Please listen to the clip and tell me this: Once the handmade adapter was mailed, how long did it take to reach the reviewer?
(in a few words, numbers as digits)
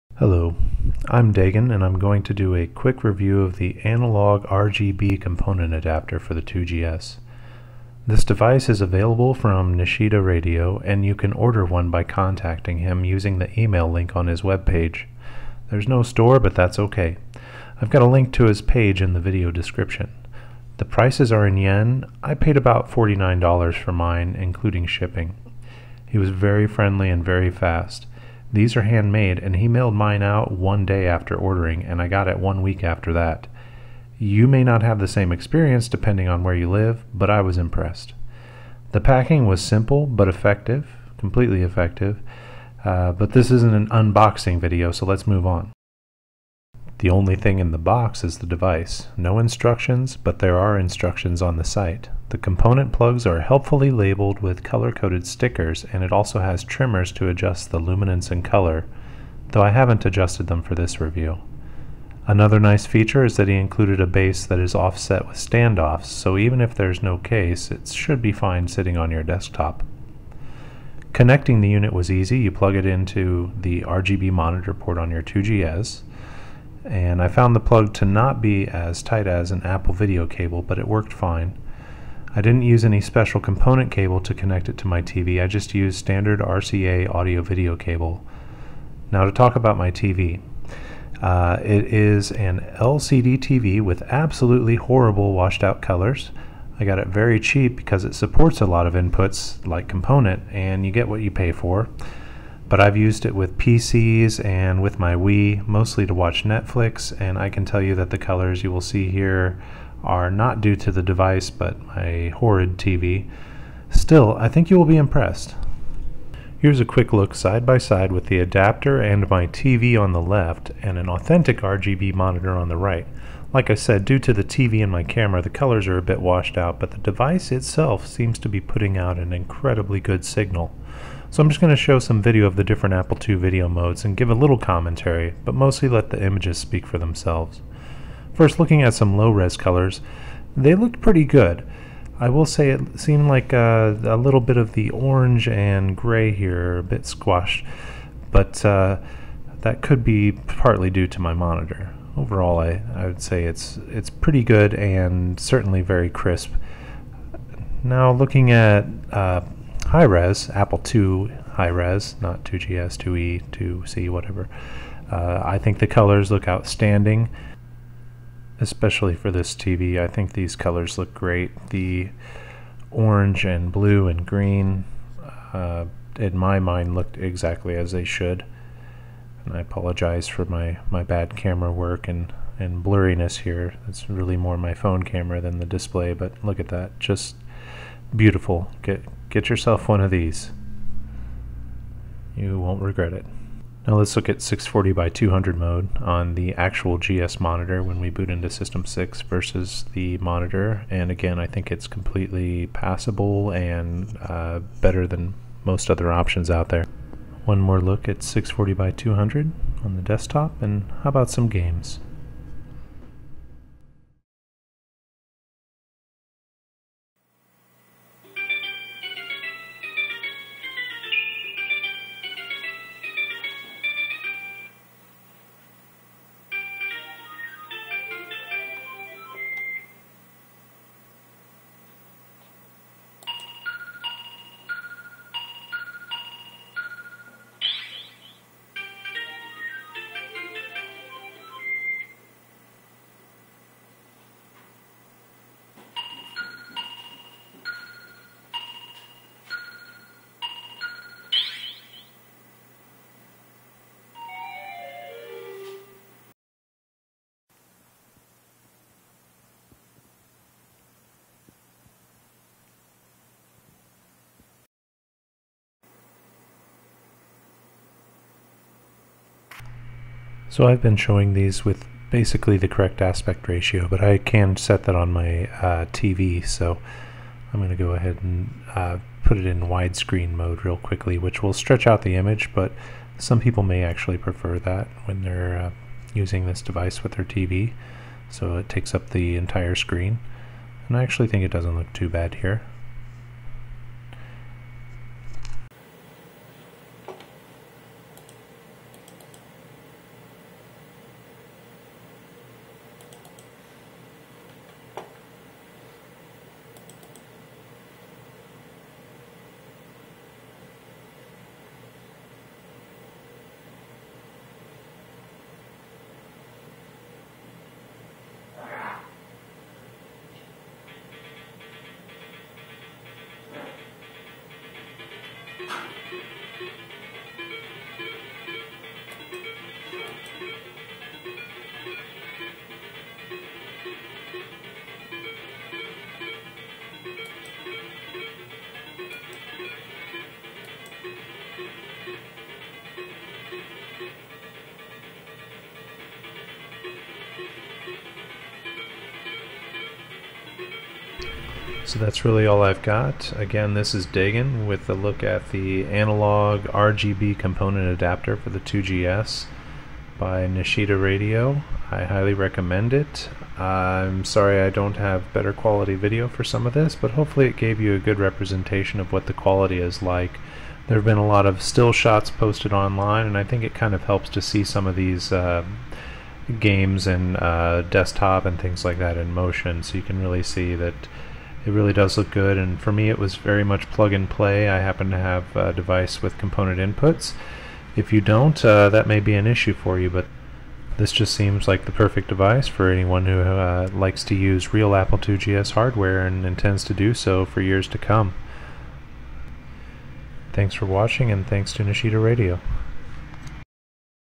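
One week.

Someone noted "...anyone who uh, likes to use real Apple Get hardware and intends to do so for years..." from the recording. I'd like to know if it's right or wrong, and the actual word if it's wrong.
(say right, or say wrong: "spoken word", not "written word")
wrong: "IIgs", not "Get".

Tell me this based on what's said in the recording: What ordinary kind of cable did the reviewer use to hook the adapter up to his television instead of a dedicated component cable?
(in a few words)
RCA audio video cable.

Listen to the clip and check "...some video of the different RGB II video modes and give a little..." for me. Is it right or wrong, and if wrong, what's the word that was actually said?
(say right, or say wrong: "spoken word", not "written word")
wrong: "Apple", not "RGB".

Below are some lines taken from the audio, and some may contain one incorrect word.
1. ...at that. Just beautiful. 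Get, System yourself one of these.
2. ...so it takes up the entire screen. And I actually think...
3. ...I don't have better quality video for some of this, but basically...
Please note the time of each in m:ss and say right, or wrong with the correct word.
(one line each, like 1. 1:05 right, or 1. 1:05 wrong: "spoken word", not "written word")
1. 3:06 wrong: "Get", not "System"
2. 4:48 right
3. 6:04 wrong: "hopefully", not "basically".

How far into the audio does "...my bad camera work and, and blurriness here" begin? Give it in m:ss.
3:00.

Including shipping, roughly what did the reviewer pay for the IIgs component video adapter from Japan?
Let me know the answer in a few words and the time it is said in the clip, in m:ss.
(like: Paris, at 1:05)
$49, at 0:22.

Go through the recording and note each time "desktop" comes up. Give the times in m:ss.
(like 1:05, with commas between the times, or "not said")
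1:09, 3:30, 6:17.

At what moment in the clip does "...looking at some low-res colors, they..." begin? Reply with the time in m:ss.
2:18.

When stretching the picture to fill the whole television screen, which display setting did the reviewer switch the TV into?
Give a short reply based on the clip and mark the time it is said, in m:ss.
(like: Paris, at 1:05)
Widescreen mode, at 4:39.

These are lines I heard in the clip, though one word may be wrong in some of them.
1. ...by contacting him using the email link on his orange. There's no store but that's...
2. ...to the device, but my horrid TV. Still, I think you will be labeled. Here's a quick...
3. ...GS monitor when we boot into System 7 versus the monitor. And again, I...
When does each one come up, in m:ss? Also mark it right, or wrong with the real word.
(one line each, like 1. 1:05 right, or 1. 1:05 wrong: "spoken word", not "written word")
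1. 0:11 wrong: "webpage", not "orange"
2. 1:50 wrong: "impressed", not "labeled"
3. 3:16 wrong: "6", not "7".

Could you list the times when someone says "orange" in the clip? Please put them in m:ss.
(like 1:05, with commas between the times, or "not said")
2:24, 2:52.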